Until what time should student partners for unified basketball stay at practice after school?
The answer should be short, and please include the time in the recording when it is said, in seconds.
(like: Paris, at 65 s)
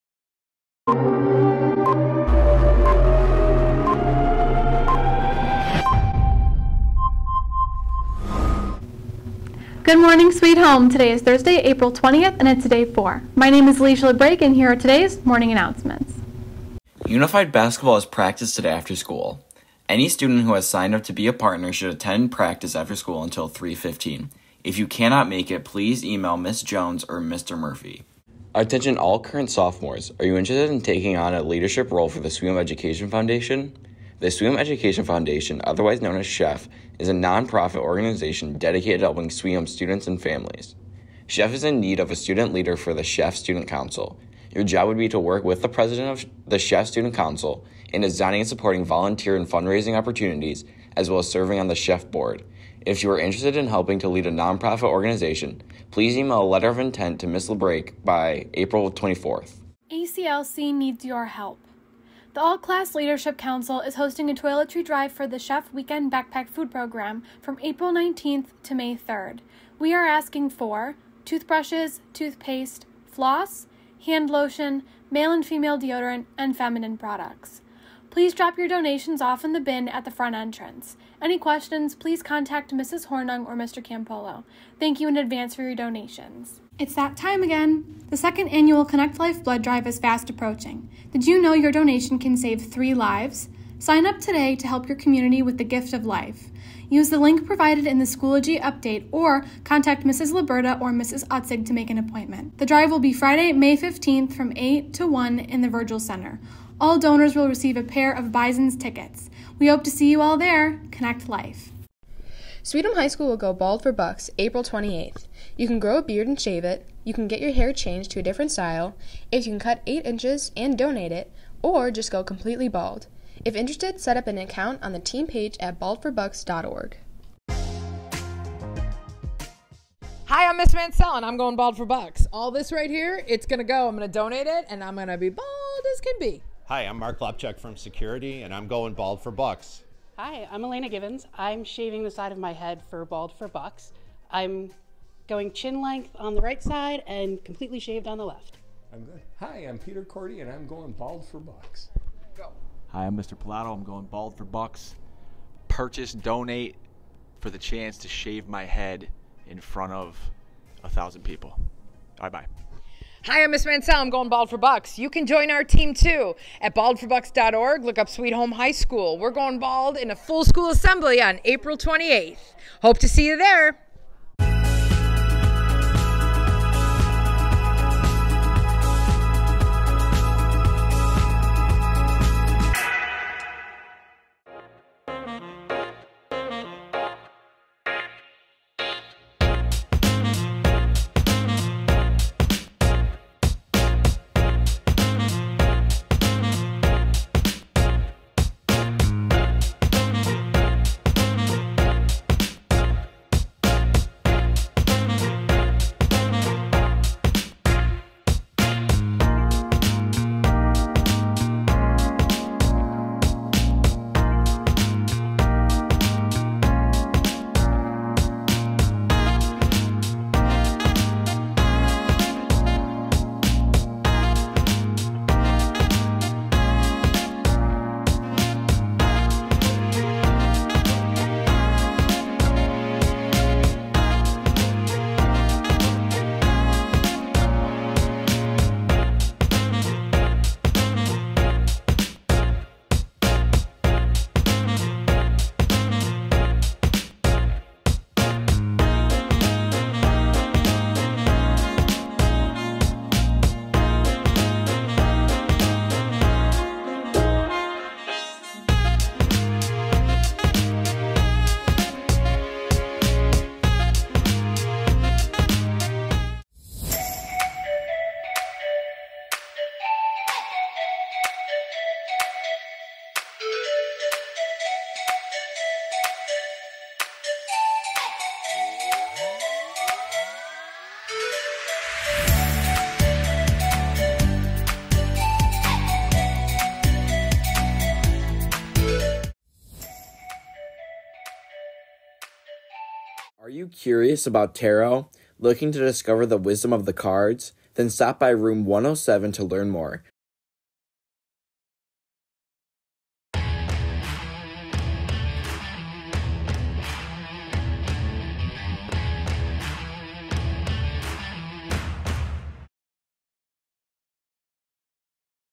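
3:15, at 23 s.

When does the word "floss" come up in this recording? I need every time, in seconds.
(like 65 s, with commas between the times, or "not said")
73 s.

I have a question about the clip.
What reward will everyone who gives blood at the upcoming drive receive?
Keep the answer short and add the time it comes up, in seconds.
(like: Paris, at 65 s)
A pair of Bison's tickets, at 107 s.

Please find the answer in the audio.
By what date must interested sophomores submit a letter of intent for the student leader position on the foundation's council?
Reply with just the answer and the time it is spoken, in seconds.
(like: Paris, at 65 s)
April 24th, at 58 s.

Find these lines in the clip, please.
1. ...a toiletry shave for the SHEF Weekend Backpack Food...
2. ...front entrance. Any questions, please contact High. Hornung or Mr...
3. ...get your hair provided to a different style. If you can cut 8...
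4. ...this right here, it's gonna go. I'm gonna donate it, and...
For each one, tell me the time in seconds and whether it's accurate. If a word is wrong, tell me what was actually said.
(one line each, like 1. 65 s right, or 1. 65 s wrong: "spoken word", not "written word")
1. 64 s wrong: "drive", not "shave"
2. 80 s wrong: "Mrs", not "High"
3. 117 s wrong: "changed", not "provided"
4. 132 s right.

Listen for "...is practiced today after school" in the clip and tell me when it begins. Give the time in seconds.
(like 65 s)
17 s.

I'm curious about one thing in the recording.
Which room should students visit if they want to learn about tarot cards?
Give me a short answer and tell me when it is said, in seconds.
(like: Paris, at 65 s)
Room 107, at 298 s.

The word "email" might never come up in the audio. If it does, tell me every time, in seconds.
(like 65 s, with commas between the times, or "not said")
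26 s, 56 s.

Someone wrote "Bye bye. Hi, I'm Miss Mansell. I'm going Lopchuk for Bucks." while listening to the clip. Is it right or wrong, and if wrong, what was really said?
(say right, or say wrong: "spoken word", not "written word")
wrong: "Bald", not "Lopchuk".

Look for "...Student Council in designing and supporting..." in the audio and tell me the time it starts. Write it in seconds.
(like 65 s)
46 s.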